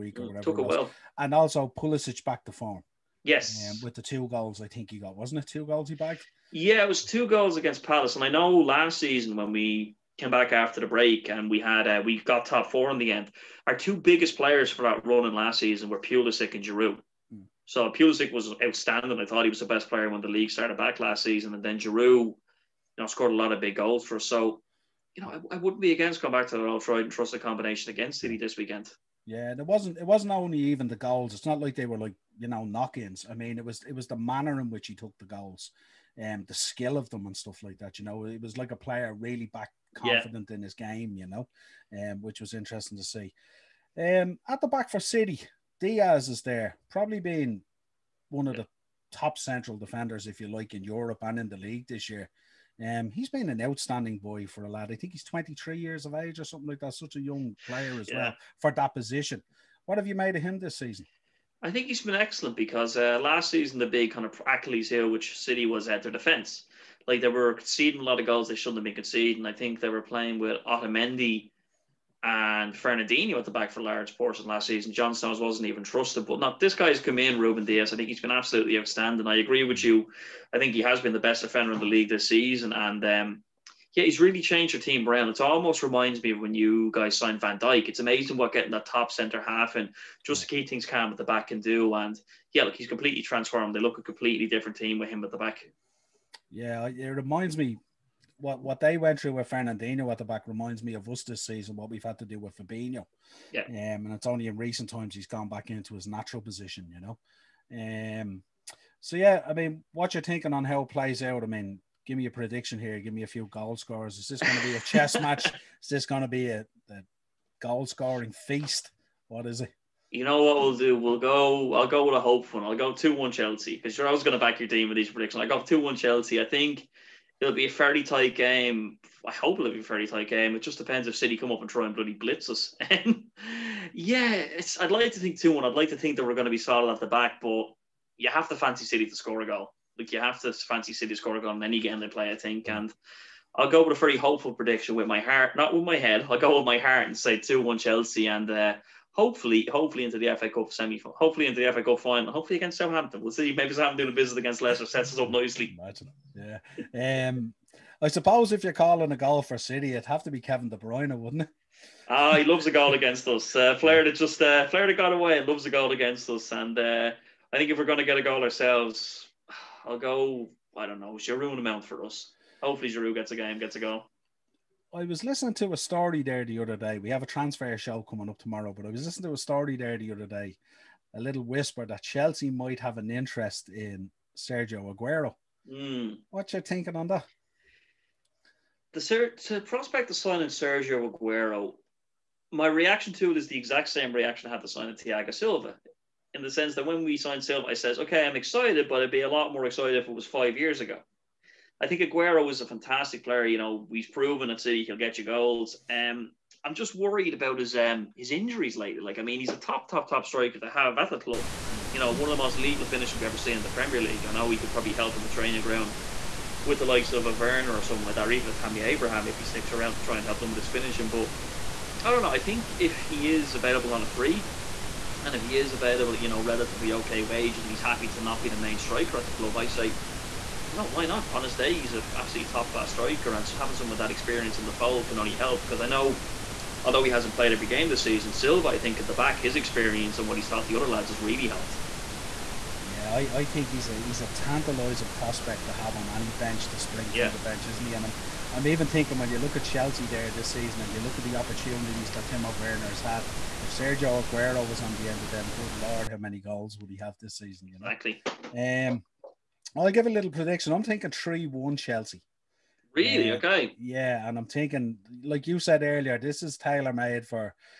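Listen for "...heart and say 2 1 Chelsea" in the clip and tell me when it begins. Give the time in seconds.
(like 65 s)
146 s.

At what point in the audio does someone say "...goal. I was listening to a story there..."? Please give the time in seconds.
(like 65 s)
173 s.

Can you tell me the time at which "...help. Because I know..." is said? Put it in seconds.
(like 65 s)
235 s.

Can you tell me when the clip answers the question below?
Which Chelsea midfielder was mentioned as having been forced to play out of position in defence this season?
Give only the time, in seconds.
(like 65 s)
102 s.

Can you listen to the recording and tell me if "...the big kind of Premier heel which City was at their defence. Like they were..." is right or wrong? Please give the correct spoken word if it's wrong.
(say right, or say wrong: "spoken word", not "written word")
wrong: "Achilles", not "Premier".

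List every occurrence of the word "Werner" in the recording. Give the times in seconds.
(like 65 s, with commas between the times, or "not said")
217 s, 252 s.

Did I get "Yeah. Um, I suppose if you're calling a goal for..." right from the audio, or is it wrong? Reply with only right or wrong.
right.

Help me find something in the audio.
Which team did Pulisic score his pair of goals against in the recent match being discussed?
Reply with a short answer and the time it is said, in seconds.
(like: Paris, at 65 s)
Palace, at 7 s.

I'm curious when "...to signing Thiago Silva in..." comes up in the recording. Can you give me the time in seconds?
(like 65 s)
194 s.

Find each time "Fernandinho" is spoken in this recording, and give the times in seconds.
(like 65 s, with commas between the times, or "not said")
72 s, 99 s.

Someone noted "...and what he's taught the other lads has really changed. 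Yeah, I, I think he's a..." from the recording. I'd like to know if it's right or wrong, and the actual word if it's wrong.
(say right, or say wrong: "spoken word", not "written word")
wrong: "helped", not "changed".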